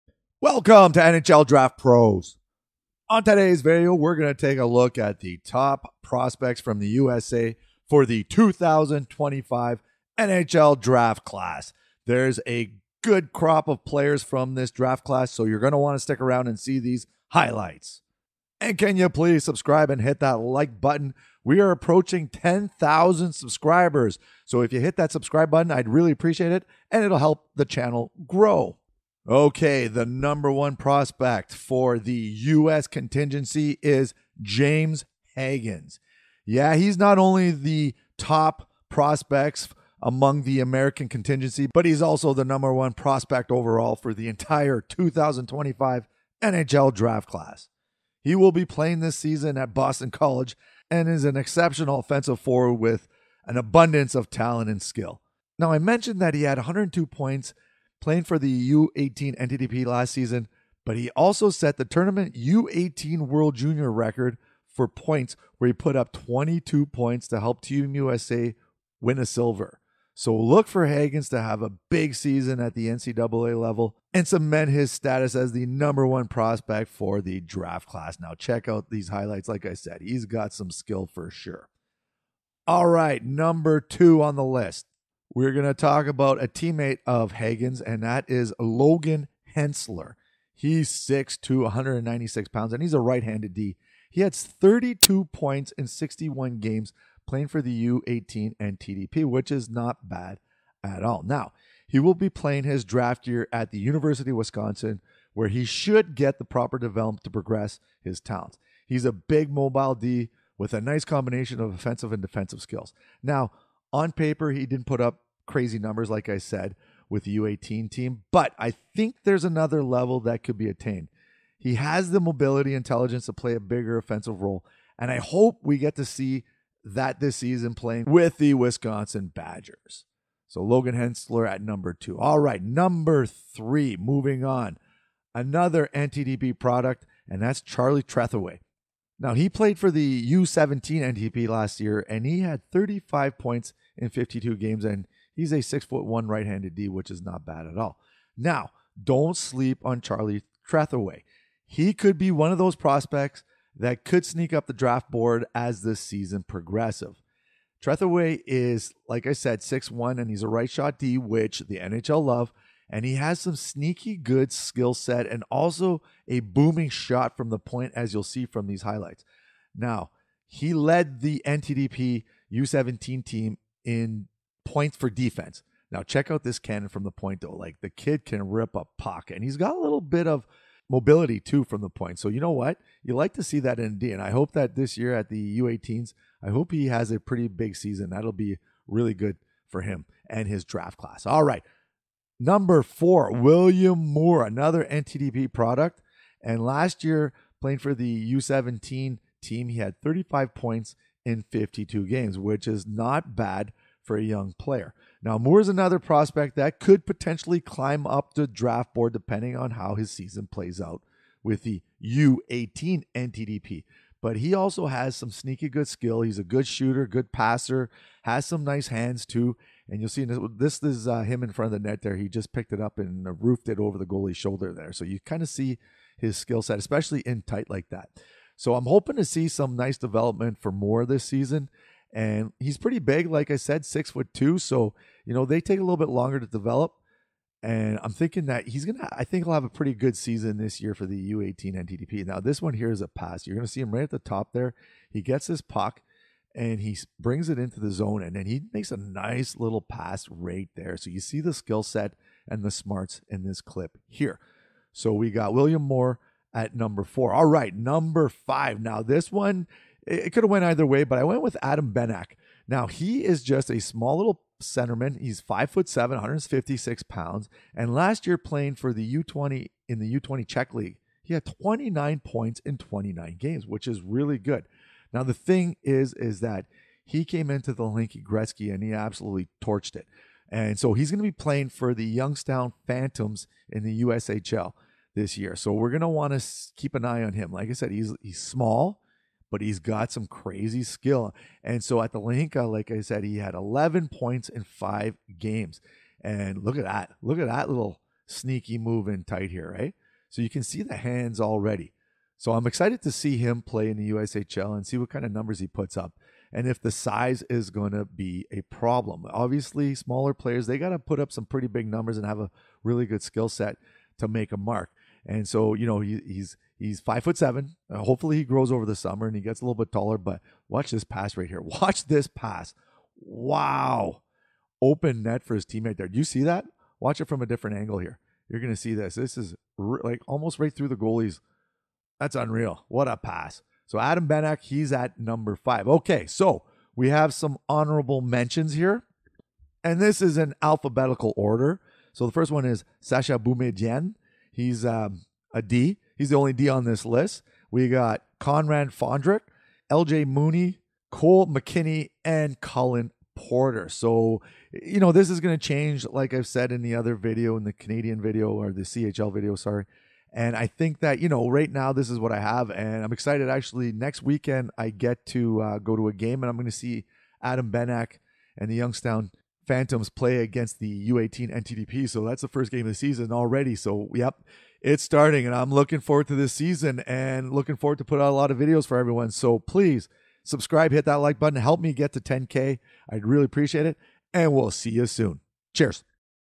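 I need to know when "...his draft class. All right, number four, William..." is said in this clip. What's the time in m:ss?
3:10.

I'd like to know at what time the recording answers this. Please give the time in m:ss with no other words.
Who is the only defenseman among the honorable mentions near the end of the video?
5:43.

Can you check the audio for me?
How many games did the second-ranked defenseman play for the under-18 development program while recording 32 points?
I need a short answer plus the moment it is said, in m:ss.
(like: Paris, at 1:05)
61, at 1:35.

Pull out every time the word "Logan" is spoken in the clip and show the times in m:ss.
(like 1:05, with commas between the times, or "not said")
1:28, 2:10.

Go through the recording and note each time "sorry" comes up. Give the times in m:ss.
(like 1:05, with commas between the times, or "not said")
5:59.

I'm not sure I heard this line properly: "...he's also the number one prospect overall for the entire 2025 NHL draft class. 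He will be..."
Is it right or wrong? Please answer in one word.
right.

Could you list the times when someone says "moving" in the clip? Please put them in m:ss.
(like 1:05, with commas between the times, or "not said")
2:13.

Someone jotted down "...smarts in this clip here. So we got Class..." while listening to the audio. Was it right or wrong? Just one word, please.
wrong.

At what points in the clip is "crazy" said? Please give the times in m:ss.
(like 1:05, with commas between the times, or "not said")
1:55, 4:50.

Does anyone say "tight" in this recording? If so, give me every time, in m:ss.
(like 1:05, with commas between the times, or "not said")
3:47, 4:59.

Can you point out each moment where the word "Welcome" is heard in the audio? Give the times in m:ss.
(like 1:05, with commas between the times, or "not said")
0:00.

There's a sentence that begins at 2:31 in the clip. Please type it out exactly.
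He could be one of those prospects that could sneak up the draft board as this season progresses.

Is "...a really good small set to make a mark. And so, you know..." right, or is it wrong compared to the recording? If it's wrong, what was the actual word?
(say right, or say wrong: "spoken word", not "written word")
wrong: "skill", not "small".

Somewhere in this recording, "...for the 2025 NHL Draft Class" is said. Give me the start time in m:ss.
0:07.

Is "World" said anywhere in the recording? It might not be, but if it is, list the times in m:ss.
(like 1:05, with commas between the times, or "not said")
1:03.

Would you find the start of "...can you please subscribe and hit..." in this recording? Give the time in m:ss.
0:18.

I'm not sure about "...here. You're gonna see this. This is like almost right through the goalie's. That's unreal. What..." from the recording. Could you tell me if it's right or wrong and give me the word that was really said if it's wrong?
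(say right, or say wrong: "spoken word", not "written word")
right.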